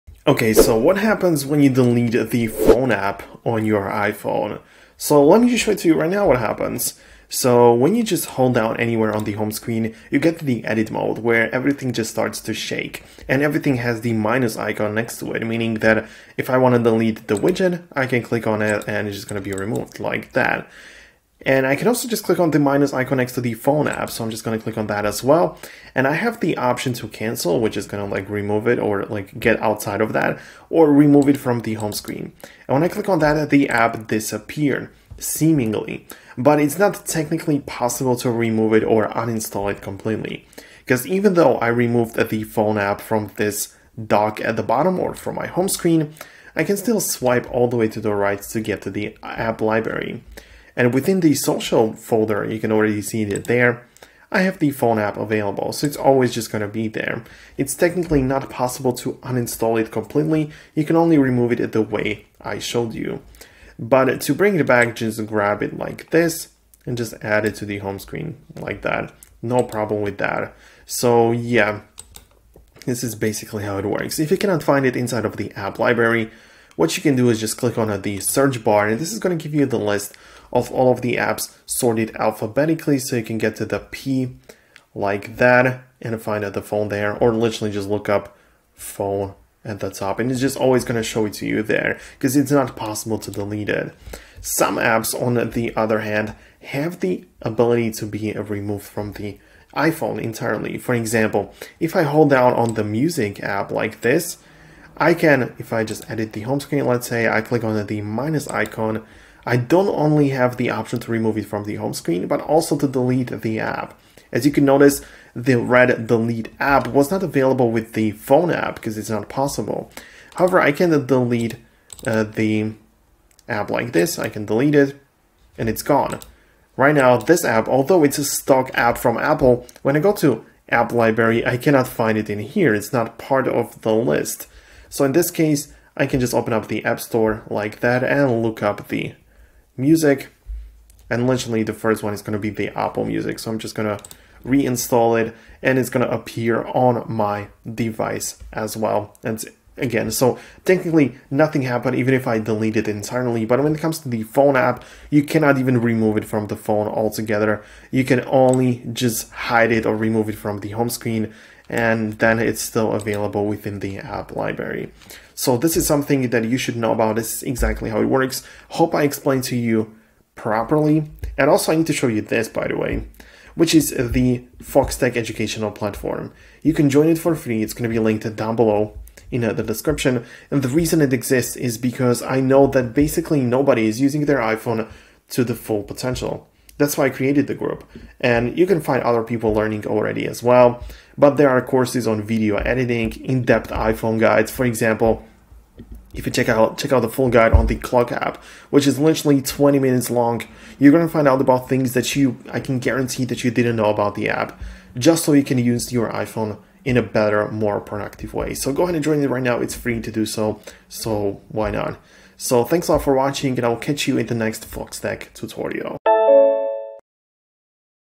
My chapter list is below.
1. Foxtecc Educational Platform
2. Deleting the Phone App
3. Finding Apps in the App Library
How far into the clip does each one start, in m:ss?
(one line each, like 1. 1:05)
1. 2:50
2. 0:27
3. 1:17.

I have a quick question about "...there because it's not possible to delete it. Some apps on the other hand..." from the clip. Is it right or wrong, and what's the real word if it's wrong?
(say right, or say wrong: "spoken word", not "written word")
right.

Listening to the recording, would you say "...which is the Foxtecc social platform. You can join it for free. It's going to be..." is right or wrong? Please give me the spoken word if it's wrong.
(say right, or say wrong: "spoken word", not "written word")
wrong: "educational", not "social".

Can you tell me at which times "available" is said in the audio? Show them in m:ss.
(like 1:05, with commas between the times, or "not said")
0:55, 1:57, 2:42.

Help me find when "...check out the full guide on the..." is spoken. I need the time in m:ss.
3:16.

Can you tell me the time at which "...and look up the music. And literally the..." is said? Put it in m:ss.
2:18.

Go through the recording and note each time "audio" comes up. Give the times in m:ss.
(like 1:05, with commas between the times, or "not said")
not said.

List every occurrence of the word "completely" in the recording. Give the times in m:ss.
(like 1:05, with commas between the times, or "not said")
0:39, 0:59.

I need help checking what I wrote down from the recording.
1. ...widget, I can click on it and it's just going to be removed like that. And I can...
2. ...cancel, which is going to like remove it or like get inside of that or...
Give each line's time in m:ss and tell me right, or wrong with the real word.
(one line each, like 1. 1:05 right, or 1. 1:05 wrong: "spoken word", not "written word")
1. 0:17 right
2. 0:27 wrong: "outside", not "inside".